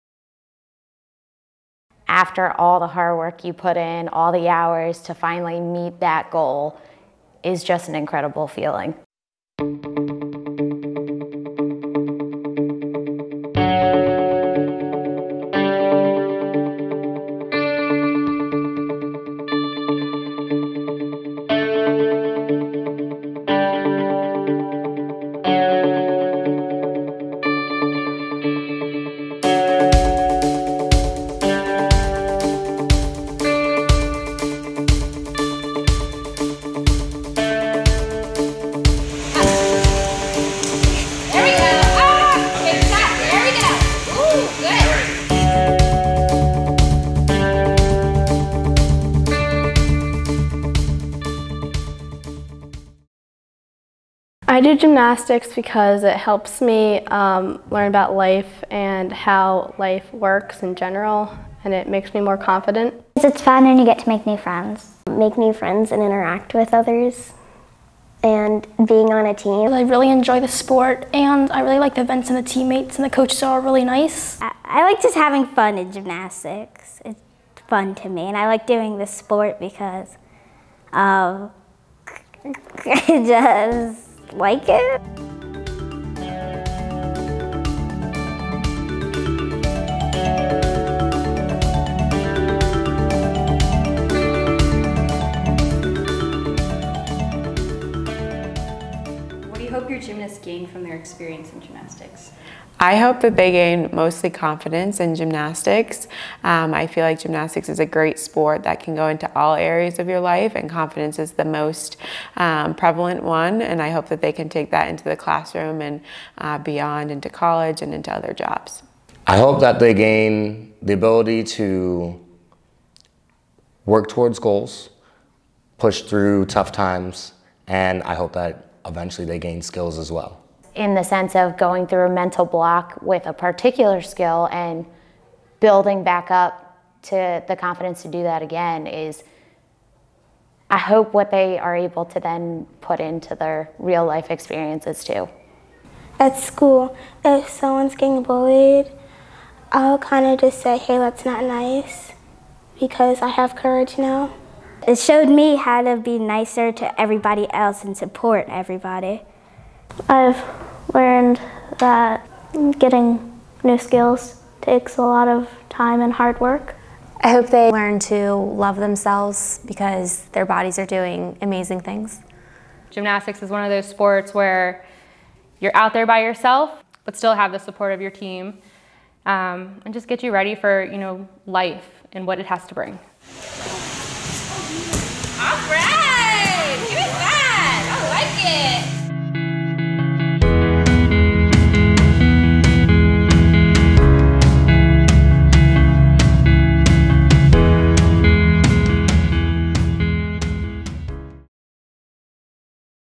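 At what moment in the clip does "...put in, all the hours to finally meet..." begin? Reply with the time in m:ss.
0:03.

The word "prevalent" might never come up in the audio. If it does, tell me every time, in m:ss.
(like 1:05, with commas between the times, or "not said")
1:52.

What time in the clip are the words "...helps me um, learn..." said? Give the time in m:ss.
0:56.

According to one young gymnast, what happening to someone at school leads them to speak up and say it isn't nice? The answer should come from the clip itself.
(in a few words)
getting bullied.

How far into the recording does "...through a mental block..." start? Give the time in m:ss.
2:11.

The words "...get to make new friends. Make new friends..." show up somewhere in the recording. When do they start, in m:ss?
1:03.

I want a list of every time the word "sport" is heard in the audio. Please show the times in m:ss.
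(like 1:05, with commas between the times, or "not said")
1:10, 1:19, 1:48, 2:53.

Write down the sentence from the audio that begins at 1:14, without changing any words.
I, I like just having fun in gymnastics.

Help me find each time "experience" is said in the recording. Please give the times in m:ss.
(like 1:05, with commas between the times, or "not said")
1:40, 2:24.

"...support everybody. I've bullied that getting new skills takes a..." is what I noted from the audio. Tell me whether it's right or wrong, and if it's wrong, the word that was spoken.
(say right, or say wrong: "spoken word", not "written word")
wrong: "learned", not "bullied".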